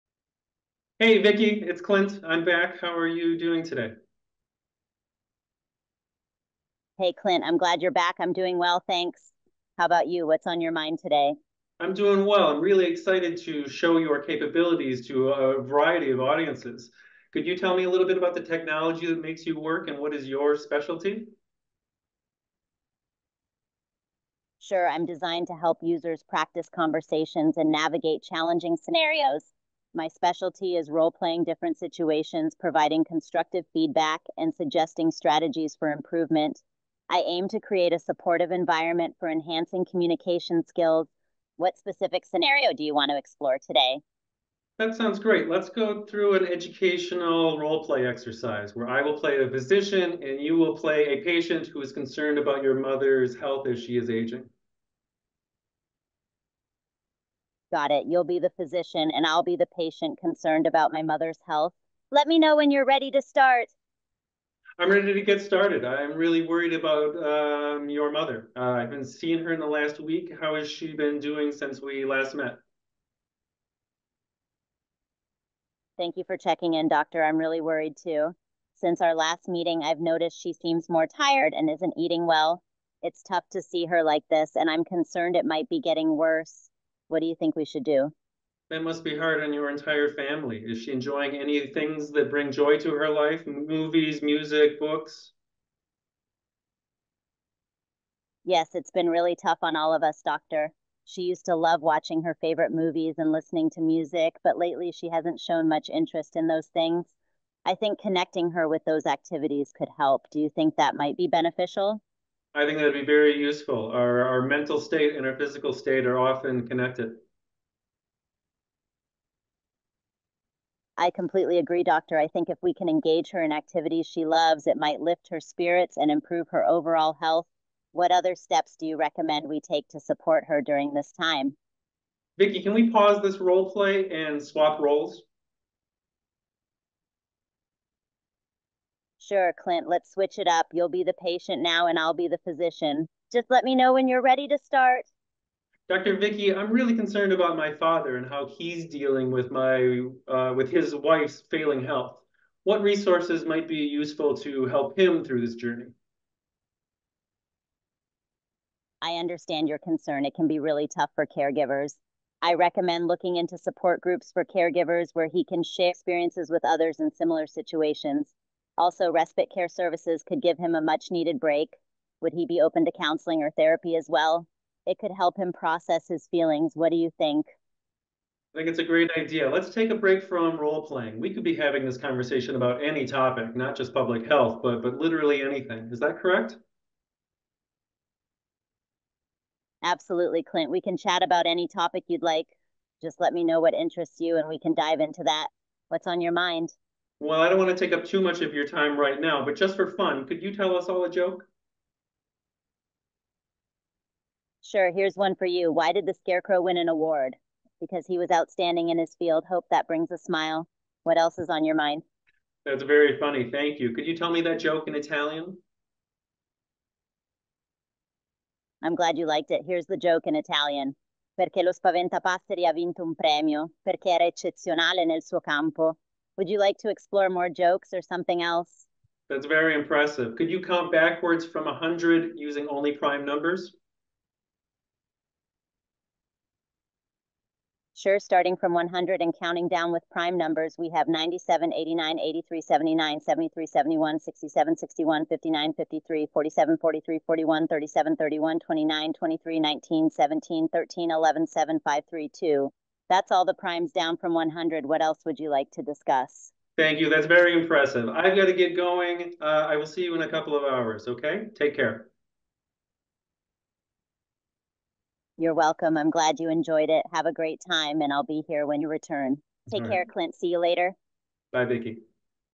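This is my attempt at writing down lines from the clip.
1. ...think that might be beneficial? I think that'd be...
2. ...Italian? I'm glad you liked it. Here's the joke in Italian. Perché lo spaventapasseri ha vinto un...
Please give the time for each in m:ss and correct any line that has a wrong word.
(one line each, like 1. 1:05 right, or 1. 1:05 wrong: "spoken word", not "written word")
1. 1:50 right
2. 3:34 right.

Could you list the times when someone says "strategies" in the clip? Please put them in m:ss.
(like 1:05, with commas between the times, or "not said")
0:35.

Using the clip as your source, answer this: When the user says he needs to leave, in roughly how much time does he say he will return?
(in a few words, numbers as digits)
A couple of hours.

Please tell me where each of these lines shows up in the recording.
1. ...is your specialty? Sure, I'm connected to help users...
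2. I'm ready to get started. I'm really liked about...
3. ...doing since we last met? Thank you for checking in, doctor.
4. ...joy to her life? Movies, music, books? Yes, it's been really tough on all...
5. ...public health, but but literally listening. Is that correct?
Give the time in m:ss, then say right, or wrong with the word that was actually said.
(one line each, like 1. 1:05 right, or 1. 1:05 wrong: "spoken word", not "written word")
1. 0:20 wrong: "designed", not "connected"
2. 1:04 wrong: "worried", not "liked"
3. 1:11 right
4. 1:32 right
5. 3:03 wrong: "anything", not "listening".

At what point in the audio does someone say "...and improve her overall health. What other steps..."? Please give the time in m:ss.
2:05.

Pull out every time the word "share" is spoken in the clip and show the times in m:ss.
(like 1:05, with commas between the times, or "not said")
2:45.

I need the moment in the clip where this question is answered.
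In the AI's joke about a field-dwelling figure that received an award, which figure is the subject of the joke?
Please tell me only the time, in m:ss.
3:26.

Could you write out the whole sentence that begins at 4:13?
That's all the primes down from 100.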